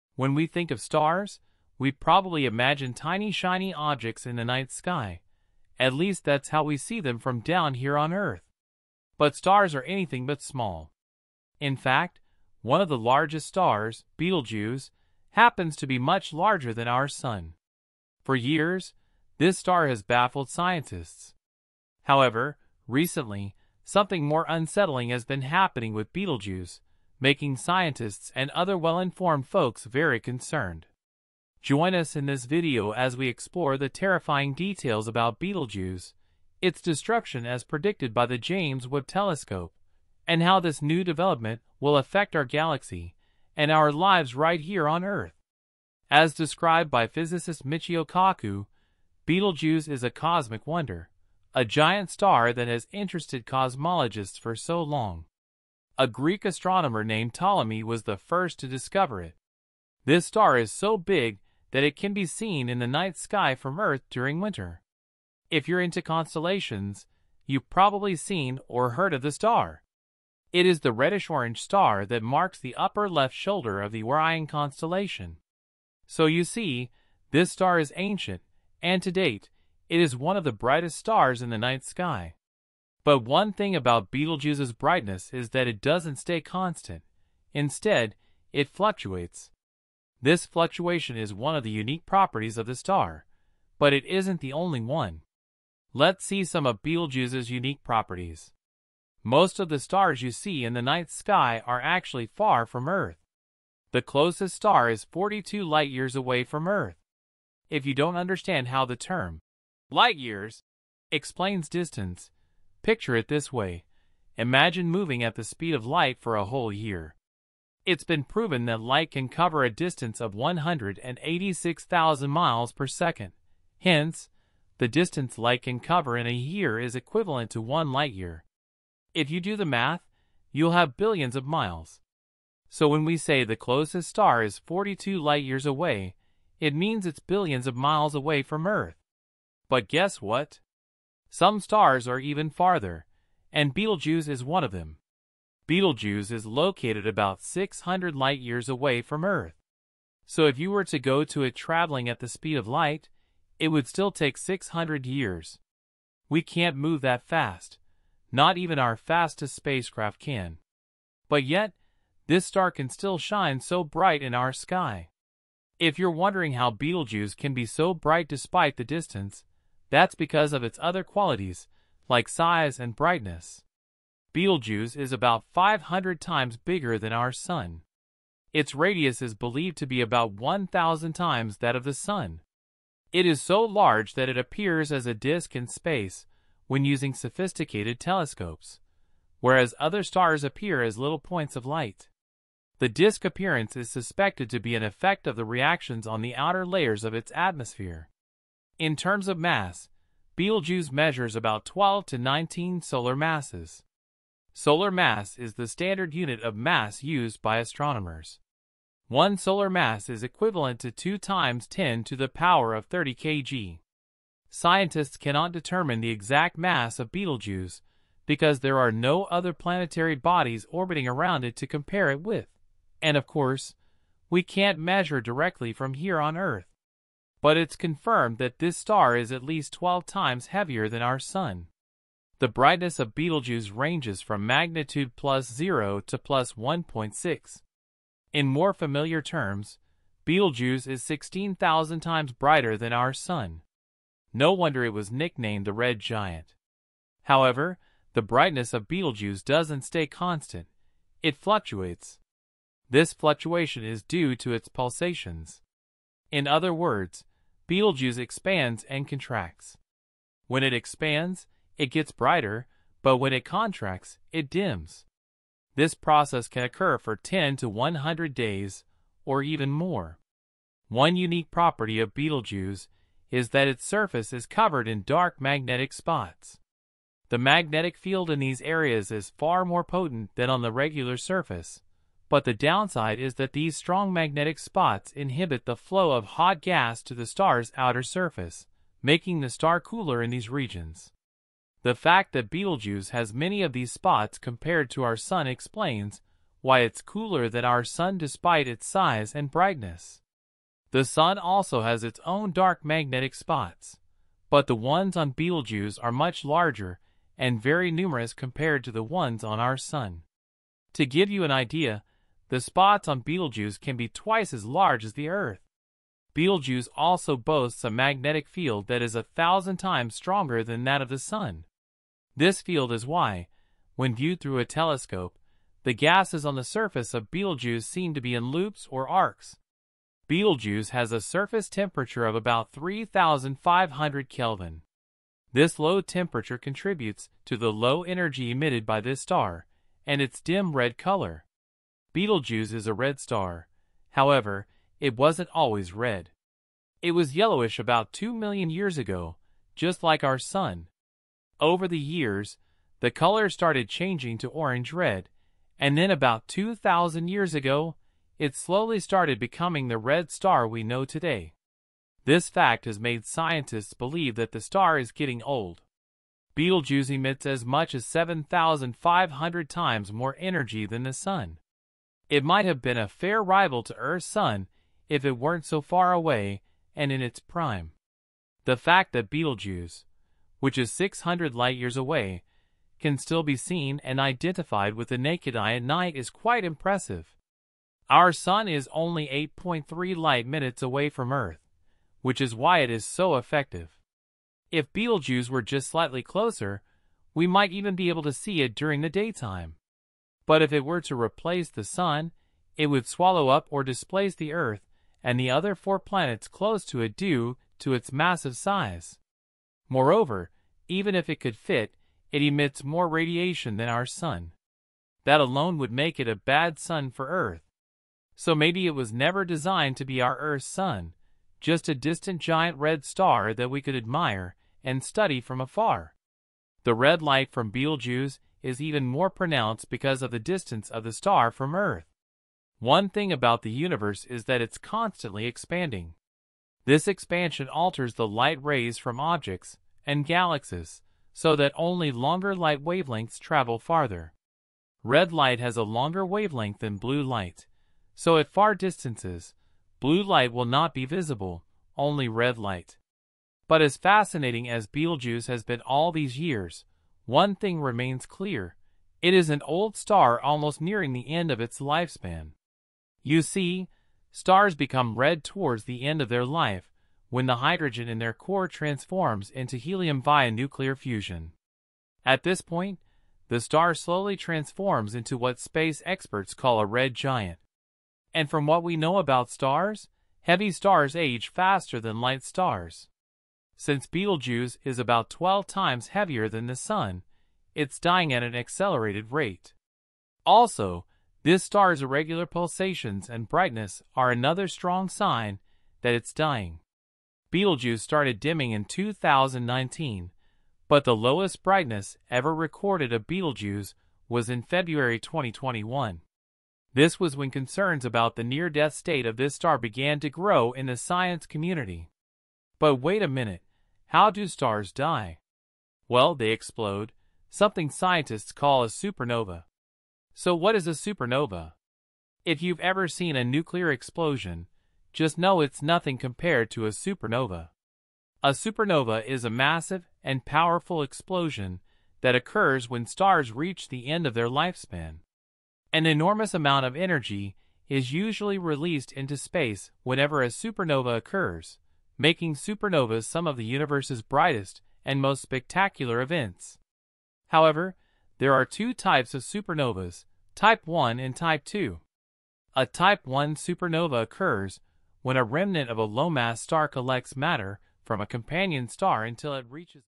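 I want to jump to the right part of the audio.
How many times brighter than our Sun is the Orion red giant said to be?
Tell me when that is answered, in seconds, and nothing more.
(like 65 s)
241 s.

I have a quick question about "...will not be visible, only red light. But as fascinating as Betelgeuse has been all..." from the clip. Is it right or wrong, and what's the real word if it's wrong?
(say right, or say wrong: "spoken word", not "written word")
right.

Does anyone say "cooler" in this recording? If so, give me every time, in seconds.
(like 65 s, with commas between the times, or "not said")
289 s, 297 s.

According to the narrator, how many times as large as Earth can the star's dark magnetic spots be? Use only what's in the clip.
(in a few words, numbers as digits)
twice.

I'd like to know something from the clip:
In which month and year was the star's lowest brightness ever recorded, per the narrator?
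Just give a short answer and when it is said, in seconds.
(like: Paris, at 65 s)
February 2021, at 504 s.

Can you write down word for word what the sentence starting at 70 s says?
It is the reddish-orange star that marks the upper left shoulder of the Orion constellation.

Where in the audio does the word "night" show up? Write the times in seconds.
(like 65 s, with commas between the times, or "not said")
4 s, 62 s, 81 s, 100 s, 385 s.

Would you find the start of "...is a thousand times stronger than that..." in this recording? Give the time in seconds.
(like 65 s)
319 s.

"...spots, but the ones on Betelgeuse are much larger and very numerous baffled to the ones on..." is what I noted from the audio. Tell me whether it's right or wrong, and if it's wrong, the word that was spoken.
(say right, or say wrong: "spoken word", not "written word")
wrong: "compared", not "baffled".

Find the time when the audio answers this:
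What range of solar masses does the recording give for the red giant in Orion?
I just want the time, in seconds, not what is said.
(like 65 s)
201 s.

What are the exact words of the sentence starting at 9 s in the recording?
But stars are anything but small.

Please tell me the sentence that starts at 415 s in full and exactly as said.
That alone would make it a bad sun for Earth.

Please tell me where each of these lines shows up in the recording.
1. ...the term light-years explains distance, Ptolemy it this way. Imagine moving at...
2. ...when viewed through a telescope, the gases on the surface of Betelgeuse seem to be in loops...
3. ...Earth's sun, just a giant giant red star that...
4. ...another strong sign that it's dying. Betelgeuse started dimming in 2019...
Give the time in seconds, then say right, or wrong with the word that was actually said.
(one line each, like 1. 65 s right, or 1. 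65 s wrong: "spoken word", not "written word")
1. 108 s wrong: "Picture", not "Ptolemy"
2. 323 s right
3. 420 s wrong: "distant", not "giant"
4. 494 s right.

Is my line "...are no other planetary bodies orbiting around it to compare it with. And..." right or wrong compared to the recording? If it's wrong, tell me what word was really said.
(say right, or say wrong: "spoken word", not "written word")
right.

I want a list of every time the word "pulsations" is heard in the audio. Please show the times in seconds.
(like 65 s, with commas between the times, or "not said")
254 s, 492 s.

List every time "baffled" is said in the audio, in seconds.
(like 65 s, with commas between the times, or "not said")
20 s.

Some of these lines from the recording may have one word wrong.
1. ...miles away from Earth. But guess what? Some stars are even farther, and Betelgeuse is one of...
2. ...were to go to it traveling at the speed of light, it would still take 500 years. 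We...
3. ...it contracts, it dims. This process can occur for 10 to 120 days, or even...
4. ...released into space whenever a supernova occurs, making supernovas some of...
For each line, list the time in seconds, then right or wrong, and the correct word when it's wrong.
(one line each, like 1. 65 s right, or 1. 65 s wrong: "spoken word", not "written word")
1. 137 s right
2. 150 s wrong: "600", not "500"
3. 263 s wrong: "100", not "120"
4. 538 s right.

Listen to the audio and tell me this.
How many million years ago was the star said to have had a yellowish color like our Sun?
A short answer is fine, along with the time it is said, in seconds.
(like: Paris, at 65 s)
2, at 348 s.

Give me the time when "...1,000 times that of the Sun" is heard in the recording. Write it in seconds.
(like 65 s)
180 s.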